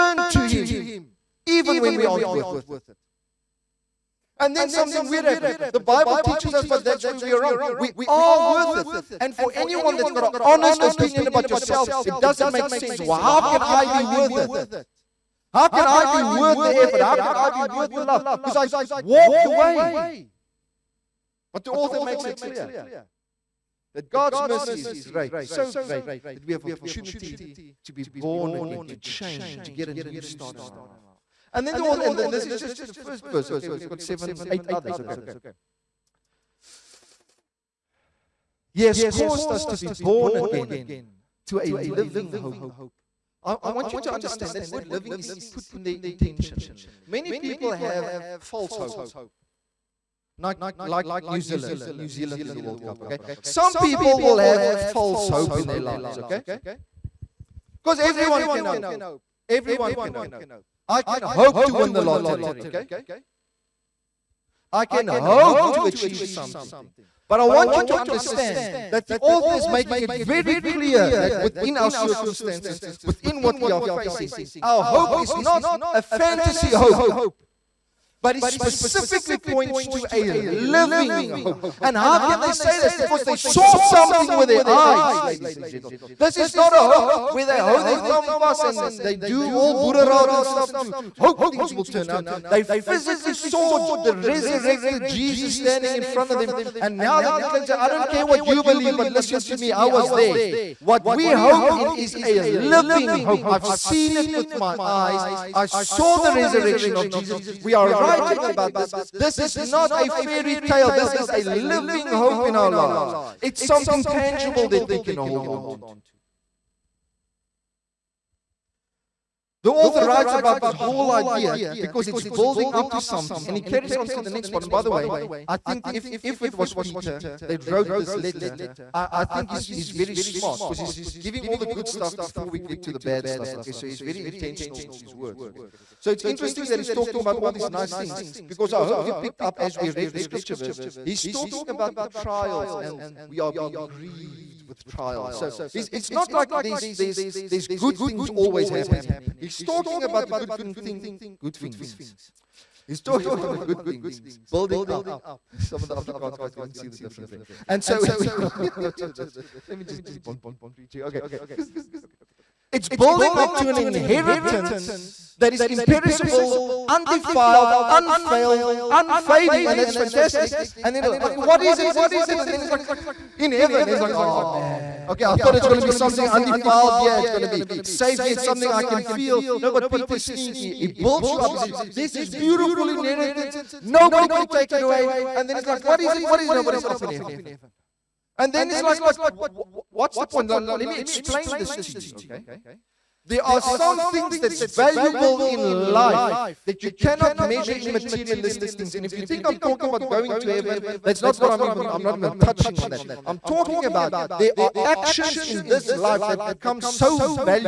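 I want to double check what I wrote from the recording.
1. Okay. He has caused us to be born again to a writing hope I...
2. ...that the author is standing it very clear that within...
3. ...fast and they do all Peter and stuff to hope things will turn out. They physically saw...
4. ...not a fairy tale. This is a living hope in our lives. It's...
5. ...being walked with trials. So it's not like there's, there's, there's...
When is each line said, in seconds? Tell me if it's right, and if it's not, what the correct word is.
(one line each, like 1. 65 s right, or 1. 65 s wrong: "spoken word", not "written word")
1. 34 s wrong: "living", not "writing"
2. 68 s wrong: "making", not "standing"
3. 88 s wrong: "Buddha", not "Peter"
4. 109 s right
5. 143 s wrong: "grieved", not "walked".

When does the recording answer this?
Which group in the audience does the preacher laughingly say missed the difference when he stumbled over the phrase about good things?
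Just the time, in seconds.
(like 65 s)
155 s.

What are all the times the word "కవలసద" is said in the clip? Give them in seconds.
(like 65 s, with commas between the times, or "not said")
not said.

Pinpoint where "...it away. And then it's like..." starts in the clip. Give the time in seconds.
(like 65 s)
184 s.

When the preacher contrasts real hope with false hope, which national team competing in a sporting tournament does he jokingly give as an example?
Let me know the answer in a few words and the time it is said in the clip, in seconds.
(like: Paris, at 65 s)
New Zealand, at 50 s.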